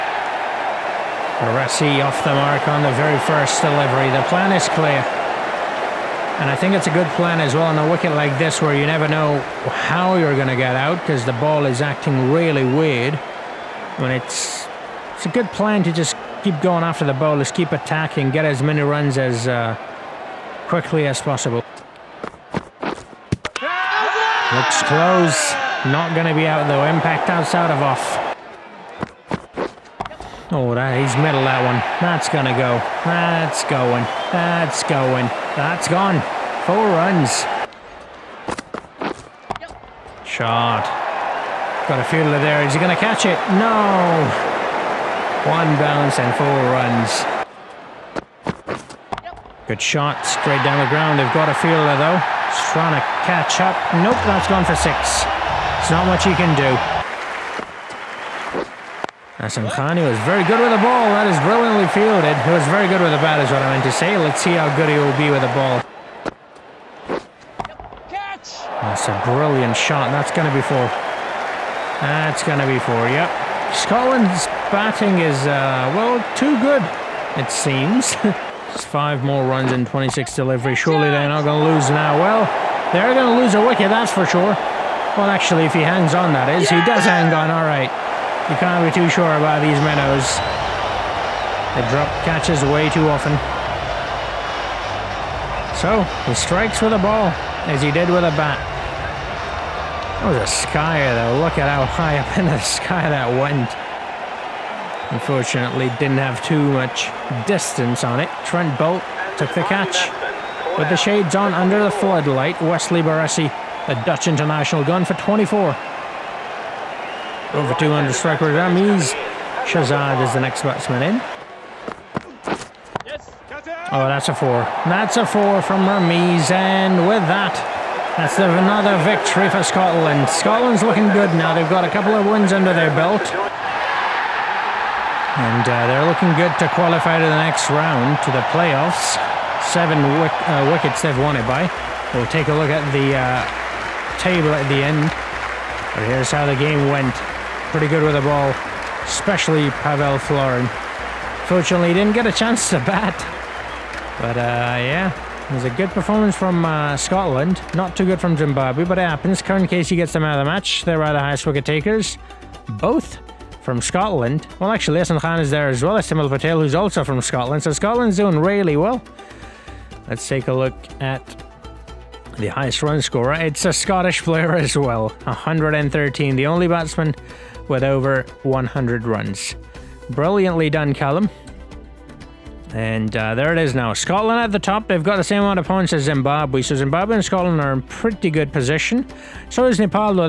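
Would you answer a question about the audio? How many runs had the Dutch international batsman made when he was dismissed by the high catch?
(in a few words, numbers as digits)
24.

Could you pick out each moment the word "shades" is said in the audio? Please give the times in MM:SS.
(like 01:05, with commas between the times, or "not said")
01:50.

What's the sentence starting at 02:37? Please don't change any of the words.
Not too good from Zimbabwe, but it happens.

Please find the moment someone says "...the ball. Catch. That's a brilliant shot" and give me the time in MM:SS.
01:05.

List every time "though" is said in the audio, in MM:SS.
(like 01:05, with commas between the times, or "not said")
00:26, 00:51, 01:41.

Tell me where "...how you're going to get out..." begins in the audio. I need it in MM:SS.
00:09.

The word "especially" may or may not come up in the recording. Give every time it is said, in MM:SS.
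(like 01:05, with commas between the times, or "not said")
02:29.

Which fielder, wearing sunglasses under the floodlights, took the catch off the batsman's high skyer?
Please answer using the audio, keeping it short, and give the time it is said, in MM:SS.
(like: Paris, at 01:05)
Trent Boult, at 01:48.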